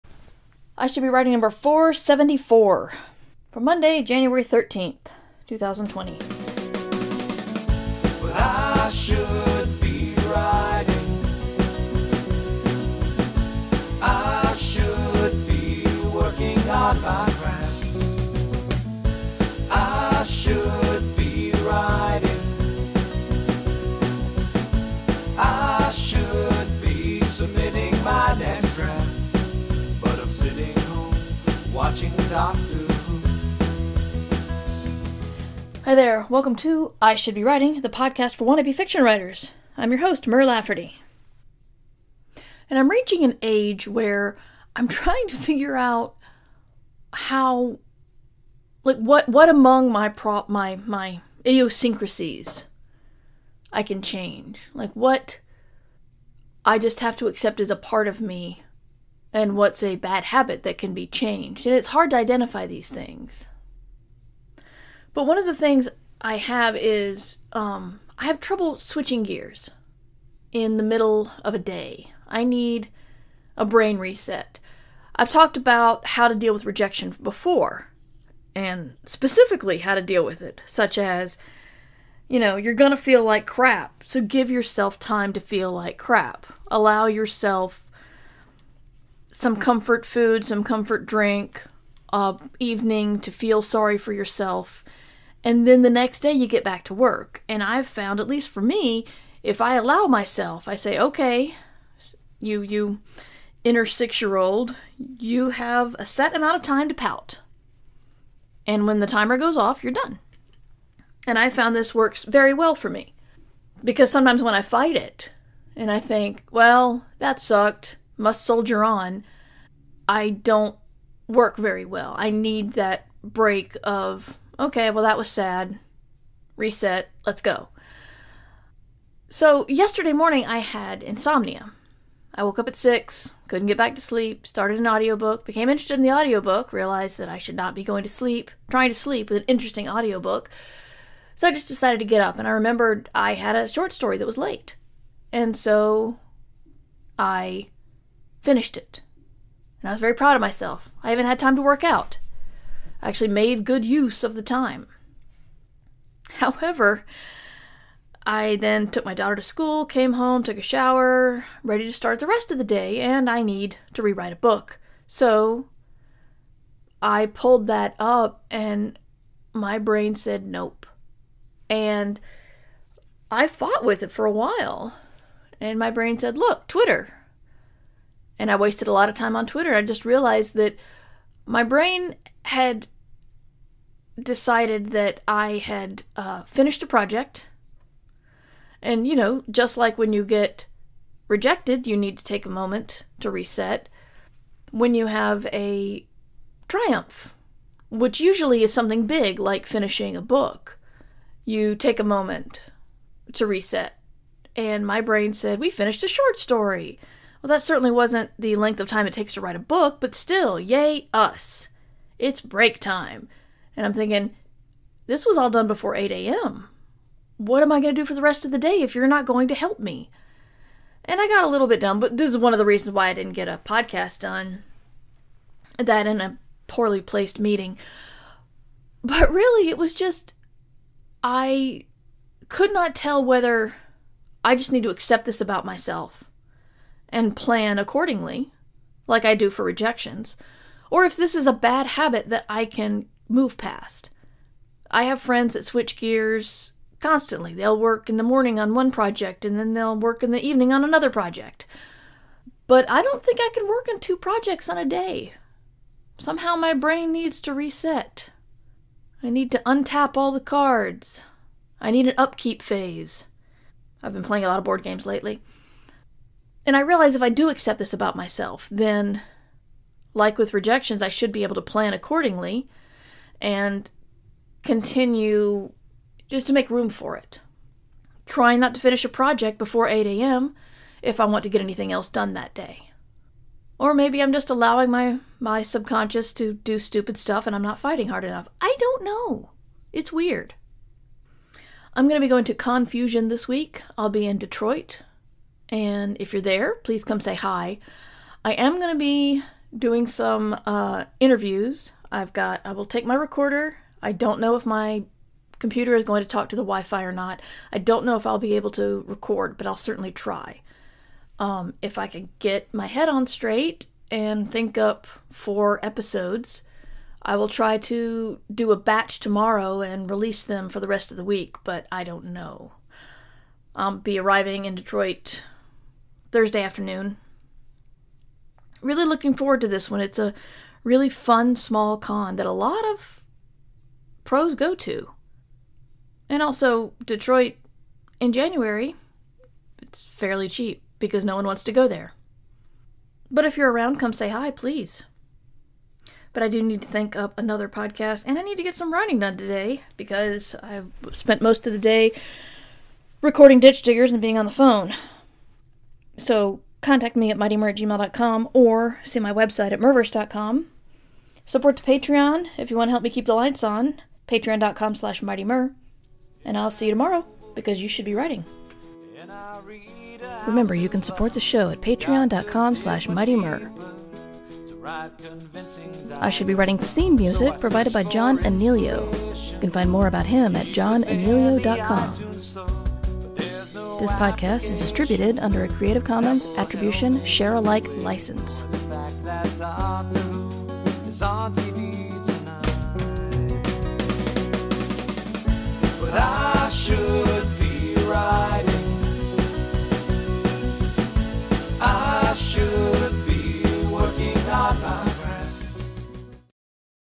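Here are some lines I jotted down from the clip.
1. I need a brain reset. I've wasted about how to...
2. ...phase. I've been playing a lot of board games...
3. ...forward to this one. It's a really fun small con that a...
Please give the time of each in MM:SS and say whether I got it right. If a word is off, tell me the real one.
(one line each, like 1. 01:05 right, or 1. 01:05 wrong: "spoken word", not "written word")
1. 01:12 wrong: "talked", not "wasted"
2. 04:22 right
3. 05:29 right.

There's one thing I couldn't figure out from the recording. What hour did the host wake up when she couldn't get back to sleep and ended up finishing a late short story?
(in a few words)
6.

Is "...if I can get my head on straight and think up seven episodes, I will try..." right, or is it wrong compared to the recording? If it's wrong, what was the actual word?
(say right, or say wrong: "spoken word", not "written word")
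wrong: "four", not "seven".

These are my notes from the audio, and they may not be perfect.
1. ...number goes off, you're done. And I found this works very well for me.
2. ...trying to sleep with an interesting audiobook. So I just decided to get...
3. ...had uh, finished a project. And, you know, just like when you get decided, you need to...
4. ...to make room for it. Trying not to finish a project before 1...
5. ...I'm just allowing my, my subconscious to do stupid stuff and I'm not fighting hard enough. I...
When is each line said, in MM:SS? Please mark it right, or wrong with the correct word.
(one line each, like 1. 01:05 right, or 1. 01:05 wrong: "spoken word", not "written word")
1. 01:49 wrong: "timer", not "number"
2. 02:18 right
3. 03:05 wrong: "rejected", not "decided"
4. 04:36 wrong: "8", not "1"
5. 04:44 right.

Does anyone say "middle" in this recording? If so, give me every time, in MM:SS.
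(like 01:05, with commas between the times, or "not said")
01:10.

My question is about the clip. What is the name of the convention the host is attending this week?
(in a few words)
Confusion.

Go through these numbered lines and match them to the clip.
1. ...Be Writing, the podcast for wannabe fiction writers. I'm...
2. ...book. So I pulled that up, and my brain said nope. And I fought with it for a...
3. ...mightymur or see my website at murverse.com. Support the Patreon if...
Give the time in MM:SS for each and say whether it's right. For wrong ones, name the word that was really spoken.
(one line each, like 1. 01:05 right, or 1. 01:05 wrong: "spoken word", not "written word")
1. 00:37 right
2. 02:44 right
3. 05:57 right.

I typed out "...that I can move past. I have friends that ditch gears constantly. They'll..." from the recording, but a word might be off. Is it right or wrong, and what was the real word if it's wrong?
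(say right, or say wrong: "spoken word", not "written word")
wrong: "switch", not "ditch".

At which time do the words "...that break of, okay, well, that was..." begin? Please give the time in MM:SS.
02:02.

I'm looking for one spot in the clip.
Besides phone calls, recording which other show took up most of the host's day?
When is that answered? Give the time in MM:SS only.
05:53.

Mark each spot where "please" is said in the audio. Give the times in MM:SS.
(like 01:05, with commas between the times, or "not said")
04:56, 05:44.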